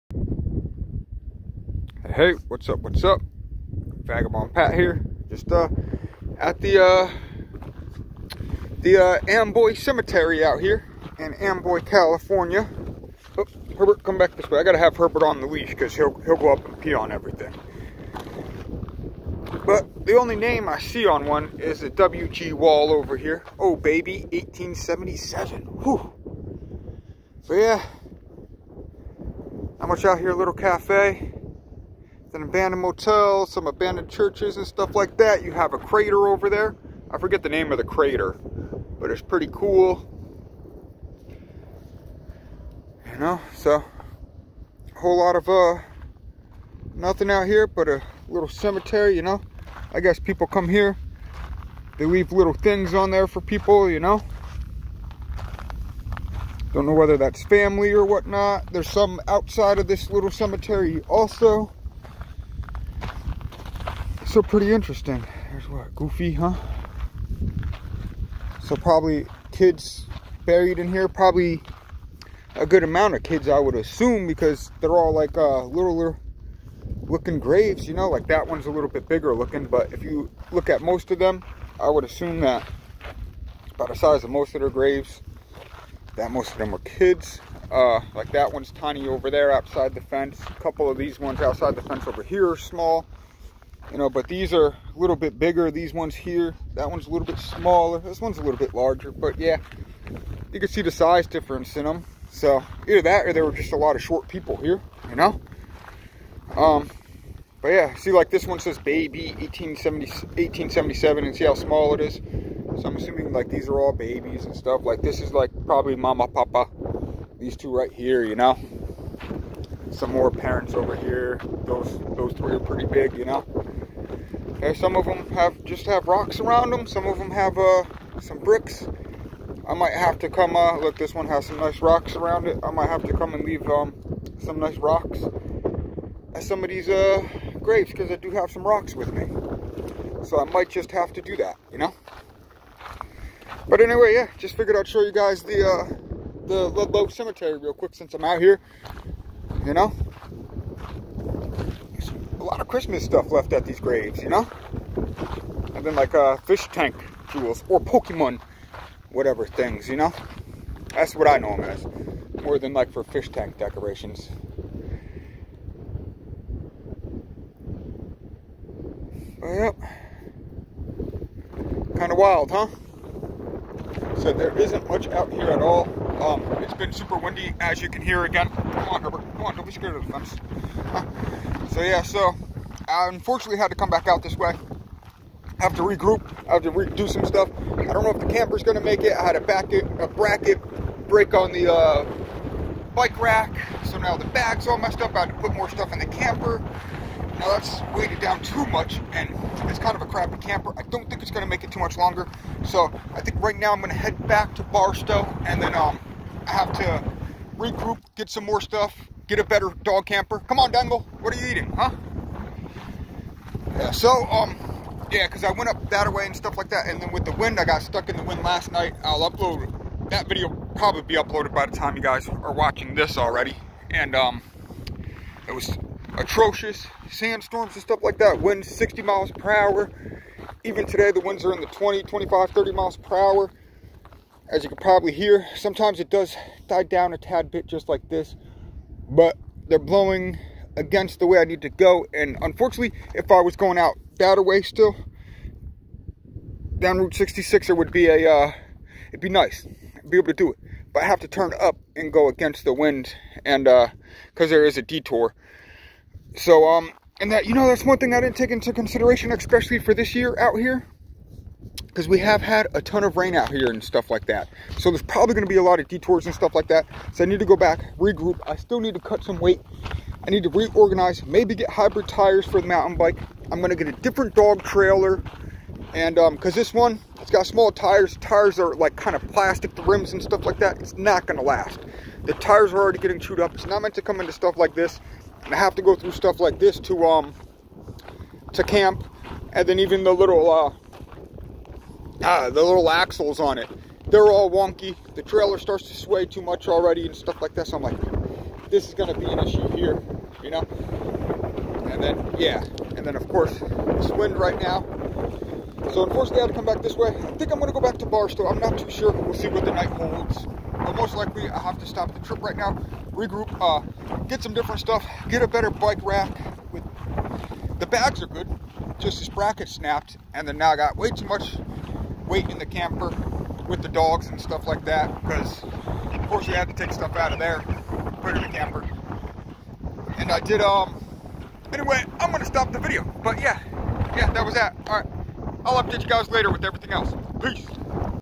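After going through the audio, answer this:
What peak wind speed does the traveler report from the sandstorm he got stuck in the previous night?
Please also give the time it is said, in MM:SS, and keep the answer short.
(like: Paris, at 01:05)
60 miles per hour, at 03:48.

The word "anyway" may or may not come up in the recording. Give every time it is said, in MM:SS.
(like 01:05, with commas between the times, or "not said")
02:23, 05:31.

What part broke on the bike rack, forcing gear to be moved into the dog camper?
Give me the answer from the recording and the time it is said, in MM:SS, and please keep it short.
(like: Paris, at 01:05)
A bracket, at 03:10.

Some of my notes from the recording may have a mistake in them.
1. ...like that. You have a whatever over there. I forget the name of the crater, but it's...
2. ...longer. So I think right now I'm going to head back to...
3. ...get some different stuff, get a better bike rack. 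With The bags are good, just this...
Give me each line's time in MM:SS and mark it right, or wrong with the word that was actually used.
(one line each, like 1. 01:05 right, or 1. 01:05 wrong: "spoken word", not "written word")
1. 00:34 wrong: "crater", not "whatever"
2. 03:21 right
3. 05:14 right.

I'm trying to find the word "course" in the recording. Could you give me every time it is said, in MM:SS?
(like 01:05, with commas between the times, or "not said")
05:03, 05:26.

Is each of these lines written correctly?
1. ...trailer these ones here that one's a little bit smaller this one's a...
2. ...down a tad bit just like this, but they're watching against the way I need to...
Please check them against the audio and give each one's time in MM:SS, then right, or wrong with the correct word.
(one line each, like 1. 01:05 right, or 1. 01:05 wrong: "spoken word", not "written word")
1. 01:35 wrong: "bigger", not "trailer"
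2. 03:56 wrong: "blowing", not "watching".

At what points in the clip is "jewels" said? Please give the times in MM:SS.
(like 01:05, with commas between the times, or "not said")
02:37.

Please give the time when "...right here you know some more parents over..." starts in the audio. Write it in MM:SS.
01:57.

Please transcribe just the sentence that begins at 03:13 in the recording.
So now the bag's all messed up.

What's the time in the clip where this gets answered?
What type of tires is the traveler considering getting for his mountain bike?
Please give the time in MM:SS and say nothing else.
04:31.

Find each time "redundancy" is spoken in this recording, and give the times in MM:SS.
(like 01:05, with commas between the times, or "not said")
not said.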